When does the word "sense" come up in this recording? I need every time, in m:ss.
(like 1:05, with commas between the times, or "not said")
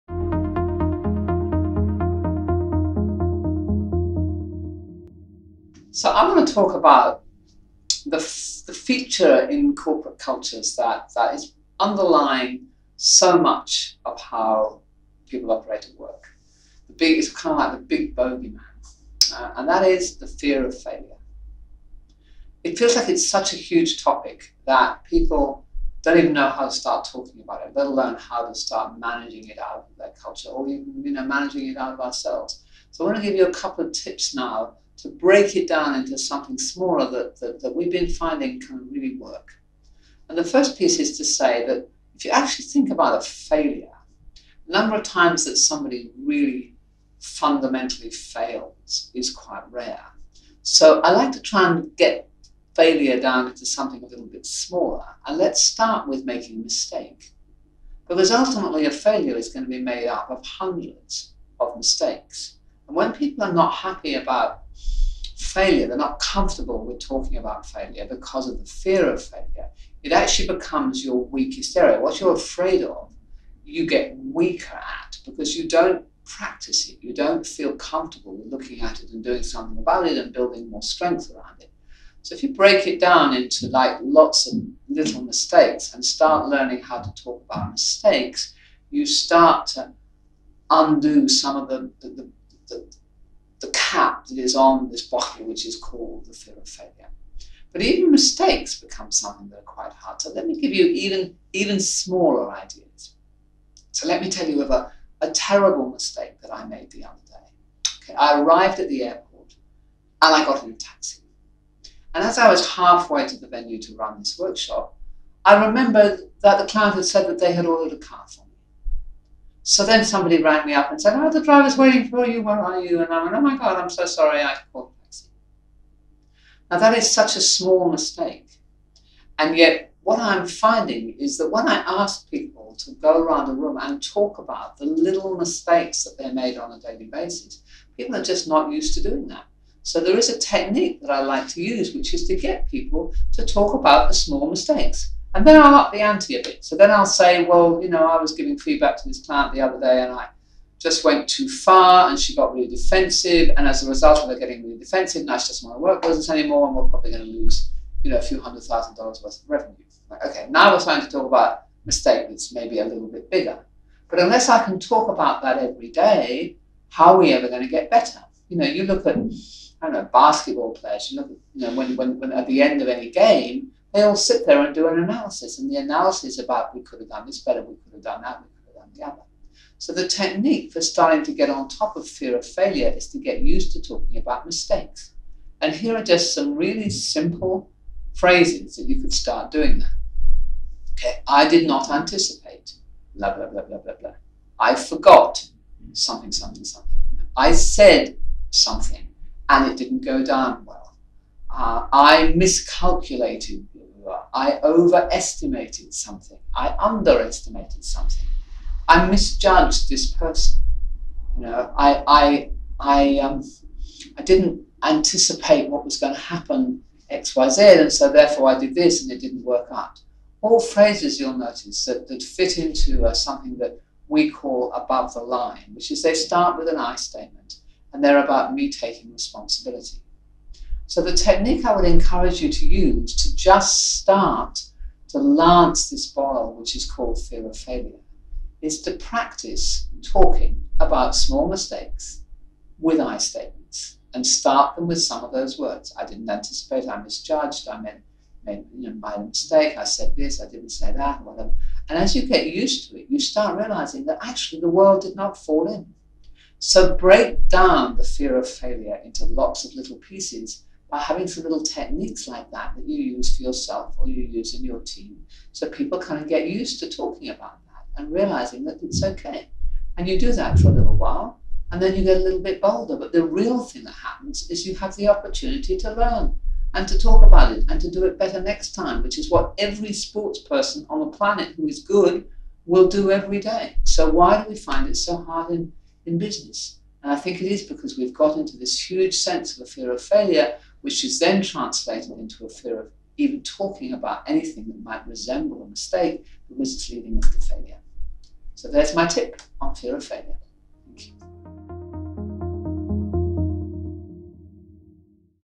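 4:49.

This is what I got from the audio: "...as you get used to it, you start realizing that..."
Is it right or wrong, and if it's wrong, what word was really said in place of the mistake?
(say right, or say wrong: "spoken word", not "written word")
right.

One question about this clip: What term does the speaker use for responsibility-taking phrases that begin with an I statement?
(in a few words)
above the line.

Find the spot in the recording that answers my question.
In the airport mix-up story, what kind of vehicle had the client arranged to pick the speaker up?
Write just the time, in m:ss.
1:57.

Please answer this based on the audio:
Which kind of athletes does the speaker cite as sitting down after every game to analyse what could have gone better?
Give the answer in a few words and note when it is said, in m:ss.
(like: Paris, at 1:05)
basketball players, at 2:50.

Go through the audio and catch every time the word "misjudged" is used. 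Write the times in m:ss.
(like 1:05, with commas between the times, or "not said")
3:29, 4:07.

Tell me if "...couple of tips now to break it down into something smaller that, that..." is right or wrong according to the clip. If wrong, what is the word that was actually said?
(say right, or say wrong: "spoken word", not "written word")
right.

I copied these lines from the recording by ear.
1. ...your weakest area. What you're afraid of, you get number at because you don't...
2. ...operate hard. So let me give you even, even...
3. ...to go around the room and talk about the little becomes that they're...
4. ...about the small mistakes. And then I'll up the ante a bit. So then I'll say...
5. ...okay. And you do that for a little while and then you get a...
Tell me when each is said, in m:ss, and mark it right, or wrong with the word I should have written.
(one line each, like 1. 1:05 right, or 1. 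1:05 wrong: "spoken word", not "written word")
1. 1:11 wrong: "weaker", not "number"
2. 1:39 wrong: "quite", not "operate"
3. 2:12 wrong: "mistakes", not "becomes"
4. 2:23 right
5. 4:29 right.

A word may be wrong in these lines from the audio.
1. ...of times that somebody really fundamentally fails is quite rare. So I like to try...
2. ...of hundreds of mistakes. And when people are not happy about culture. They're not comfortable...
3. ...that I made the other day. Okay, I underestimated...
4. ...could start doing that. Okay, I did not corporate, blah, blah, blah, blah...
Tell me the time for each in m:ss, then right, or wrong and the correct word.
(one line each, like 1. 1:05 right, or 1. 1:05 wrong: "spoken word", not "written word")
1. 0:44 right
2. 1:00 wrong: "failure", not "culture"
3. 1:46 wrong: "arrived", not "underestimated"
4. 3:09 wrong: "anticipate", not "corporate".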